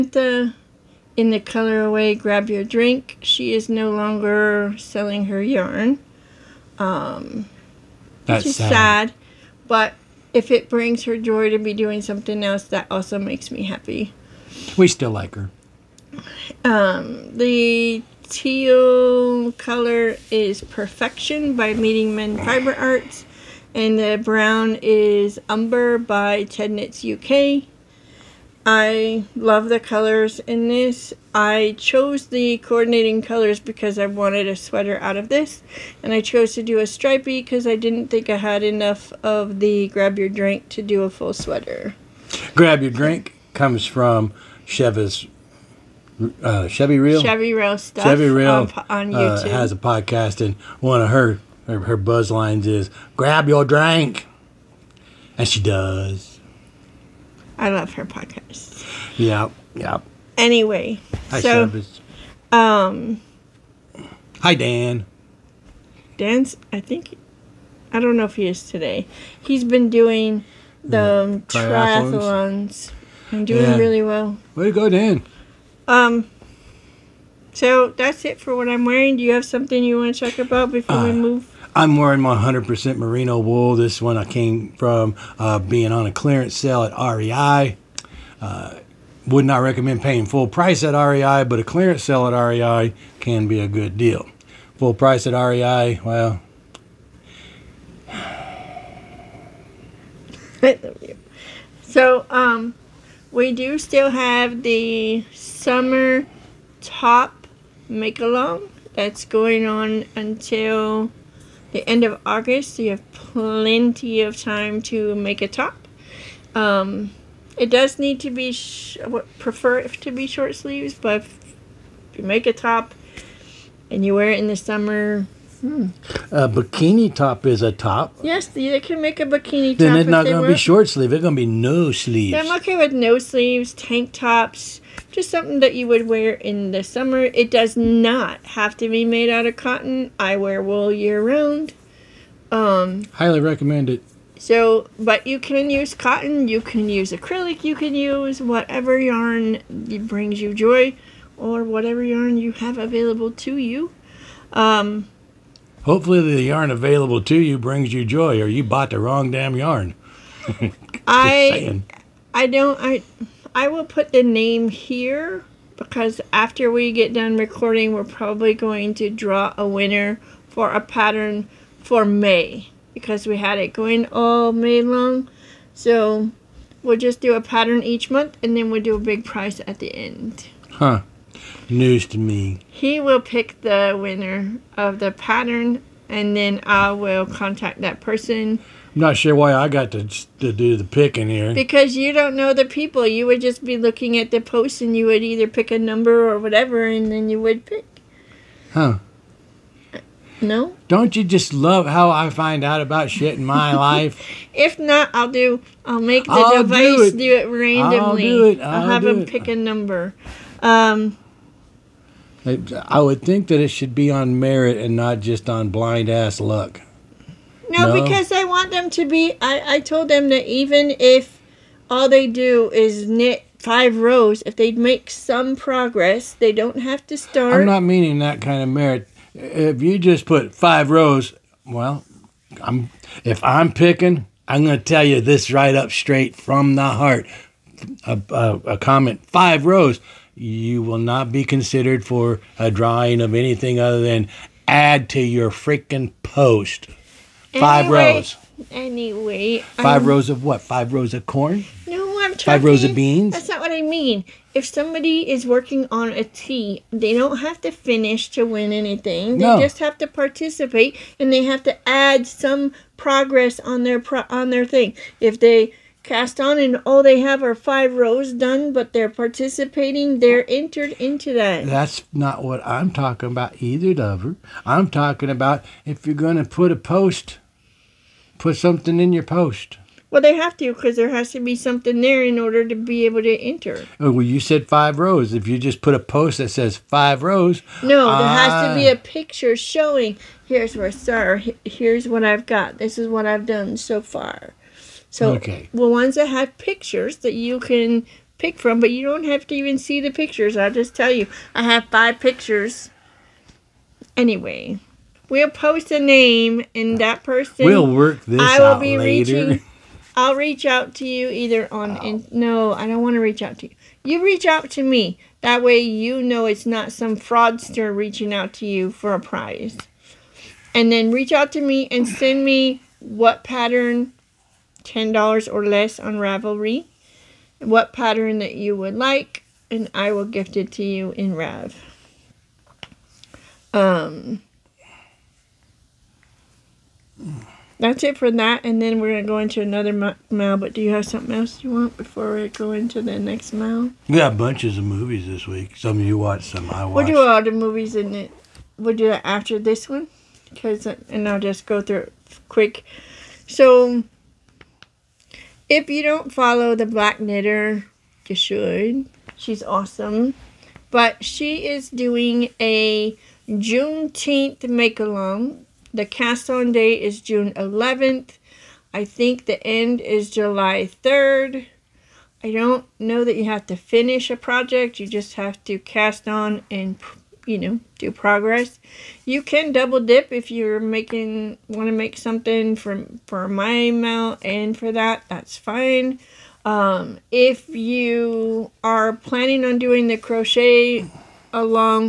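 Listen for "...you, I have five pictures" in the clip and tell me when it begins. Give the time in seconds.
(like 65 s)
301 s.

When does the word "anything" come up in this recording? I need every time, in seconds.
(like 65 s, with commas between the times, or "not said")
243 s, 258 s.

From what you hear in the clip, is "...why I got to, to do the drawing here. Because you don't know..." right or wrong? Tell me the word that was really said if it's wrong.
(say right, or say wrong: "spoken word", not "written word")
wrong: "picking", not "drawing".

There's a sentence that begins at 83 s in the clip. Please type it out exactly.
This one I came from uh, being on a clearance sale at REI.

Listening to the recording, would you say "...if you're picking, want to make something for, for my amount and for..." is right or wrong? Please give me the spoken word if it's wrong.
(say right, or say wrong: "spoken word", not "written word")
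wrong: "making", not "picking".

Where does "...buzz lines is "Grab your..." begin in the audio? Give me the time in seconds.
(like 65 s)
51 s.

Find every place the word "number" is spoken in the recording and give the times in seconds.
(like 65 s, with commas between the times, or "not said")
195 s, 209 s.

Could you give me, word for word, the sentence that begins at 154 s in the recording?
Um, Hopefully, the yarn available to you brings you joy, or you bought the wrong damn yarn.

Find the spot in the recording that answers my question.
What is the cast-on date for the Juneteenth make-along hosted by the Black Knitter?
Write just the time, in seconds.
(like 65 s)
367 s.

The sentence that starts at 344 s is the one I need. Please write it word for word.
We got bunches of movies this week.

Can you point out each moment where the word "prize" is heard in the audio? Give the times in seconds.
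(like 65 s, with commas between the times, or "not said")
179 s, 319 s.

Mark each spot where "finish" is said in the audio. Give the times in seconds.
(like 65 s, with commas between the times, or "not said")
257 s, 373 s.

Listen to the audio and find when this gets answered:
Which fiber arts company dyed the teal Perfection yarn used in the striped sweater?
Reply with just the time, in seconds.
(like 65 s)
21 s.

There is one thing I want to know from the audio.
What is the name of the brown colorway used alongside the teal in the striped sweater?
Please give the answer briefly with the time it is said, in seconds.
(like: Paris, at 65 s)
Umber, at 25 s.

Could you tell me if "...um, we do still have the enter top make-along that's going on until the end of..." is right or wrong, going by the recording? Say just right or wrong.
wrong.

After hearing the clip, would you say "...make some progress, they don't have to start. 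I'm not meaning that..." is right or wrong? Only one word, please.
right.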